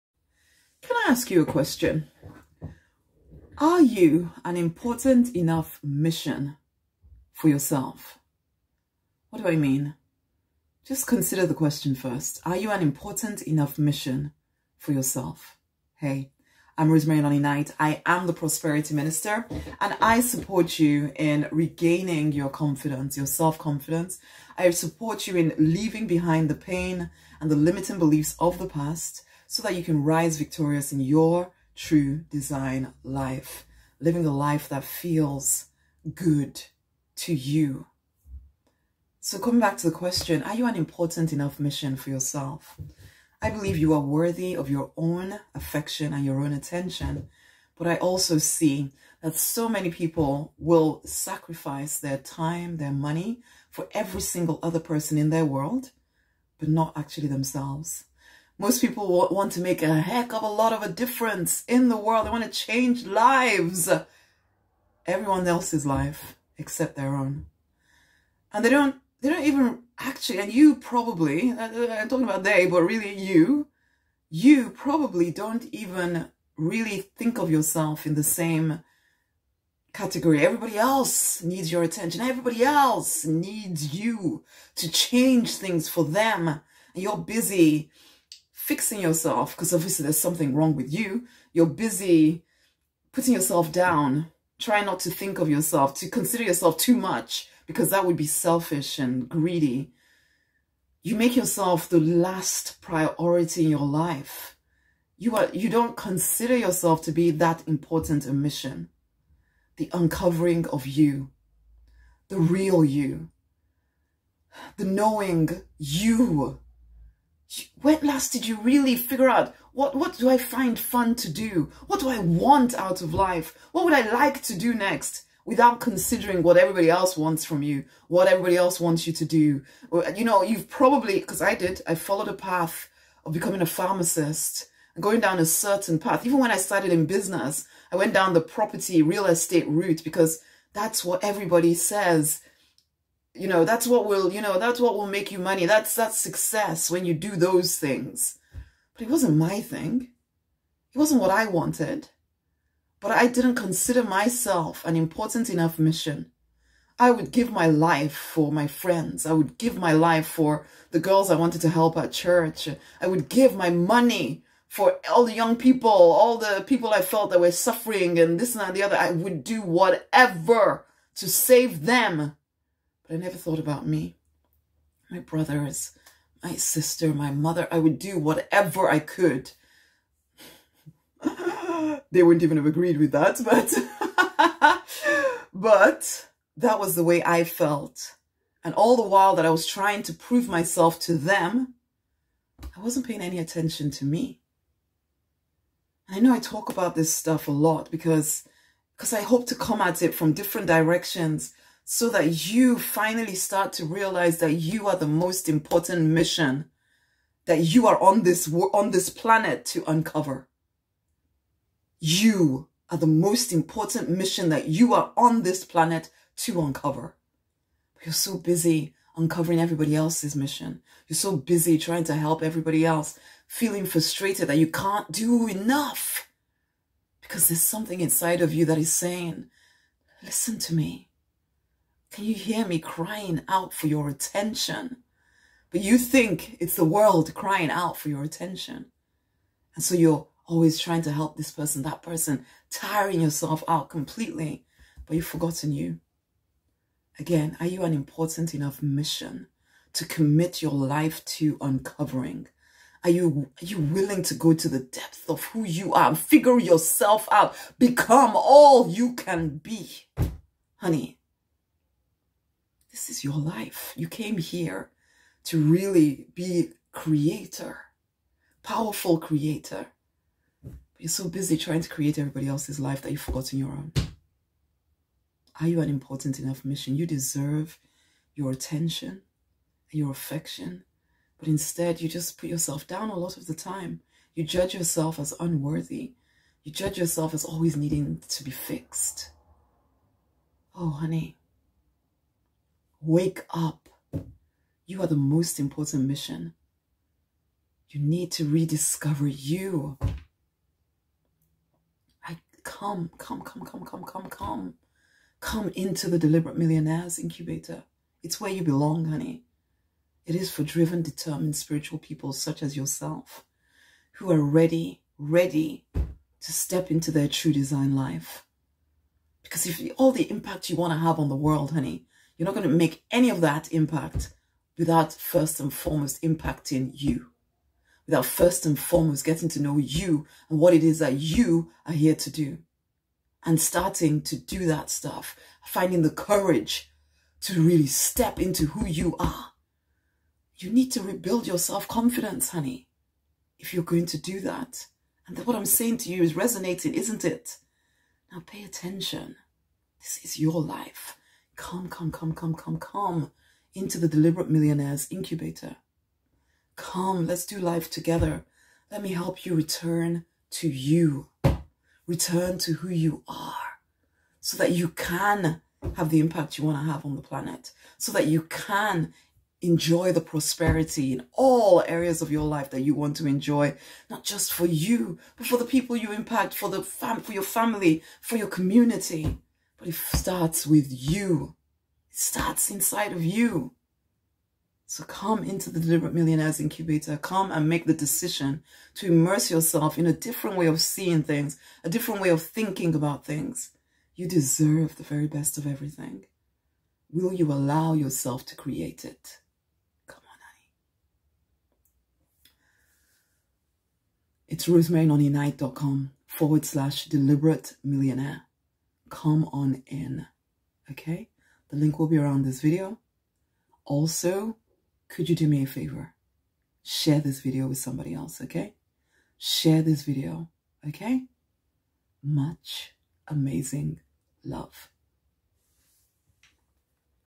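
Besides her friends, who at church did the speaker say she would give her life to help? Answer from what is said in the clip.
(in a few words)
The girls.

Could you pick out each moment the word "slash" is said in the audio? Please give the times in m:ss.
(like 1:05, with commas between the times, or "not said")
6:46.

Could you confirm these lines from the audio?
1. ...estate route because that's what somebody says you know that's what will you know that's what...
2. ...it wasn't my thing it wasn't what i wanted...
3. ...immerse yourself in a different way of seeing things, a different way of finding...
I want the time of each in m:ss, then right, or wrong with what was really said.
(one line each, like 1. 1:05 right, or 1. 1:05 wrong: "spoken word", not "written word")
1. 2:19 wrong: "everybody", not "somebody"
2. 2:29 right
3. 6:29 wrong: "thinking", not "finding".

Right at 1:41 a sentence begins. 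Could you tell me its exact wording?
You make yourself the last priority in your life.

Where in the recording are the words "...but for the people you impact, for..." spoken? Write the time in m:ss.
6:15.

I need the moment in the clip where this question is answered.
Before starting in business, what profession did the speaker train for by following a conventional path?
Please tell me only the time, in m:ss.
2:13.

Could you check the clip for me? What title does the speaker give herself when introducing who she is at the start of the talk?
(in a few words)
Prosperity Minister.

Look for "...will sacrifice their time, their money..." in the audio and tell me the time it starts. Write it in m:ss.
0:50.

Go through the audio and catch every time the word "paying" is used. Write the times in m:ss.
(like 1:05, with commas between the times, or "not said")
3:13.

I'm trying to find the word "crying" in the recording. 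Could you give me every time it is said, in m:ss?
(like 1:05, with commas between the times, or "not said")
3:52, 3:57.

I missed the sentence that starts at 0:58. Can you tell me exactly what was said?
Most people want to make a heck of a lot of a difference in the world.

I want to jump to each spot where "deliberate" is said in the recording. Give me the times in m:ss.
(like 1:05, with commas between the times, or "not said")
5:06, 5:54, 6:25, 6:47.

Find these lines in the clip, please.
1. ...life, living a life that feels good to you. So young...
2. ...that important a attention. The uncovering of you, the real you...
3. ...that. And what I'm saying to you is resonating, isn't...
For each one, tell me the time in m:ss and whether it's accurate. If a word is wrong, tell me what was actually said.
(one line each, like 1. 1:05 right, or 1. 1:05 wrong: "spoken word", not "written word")
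1. 0:33 wrong: "coming", not "young"
2. 1:47 wrong: "mission", not "attention"
3. 5:44 right.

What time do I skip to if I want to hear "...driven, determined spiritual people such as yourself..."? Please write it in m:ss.
5:10.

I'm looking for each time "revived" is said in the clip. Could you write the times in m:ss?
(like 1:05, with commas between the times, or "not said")
not said.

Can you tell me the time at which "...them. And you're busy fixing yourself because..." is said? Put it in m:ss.
1:26.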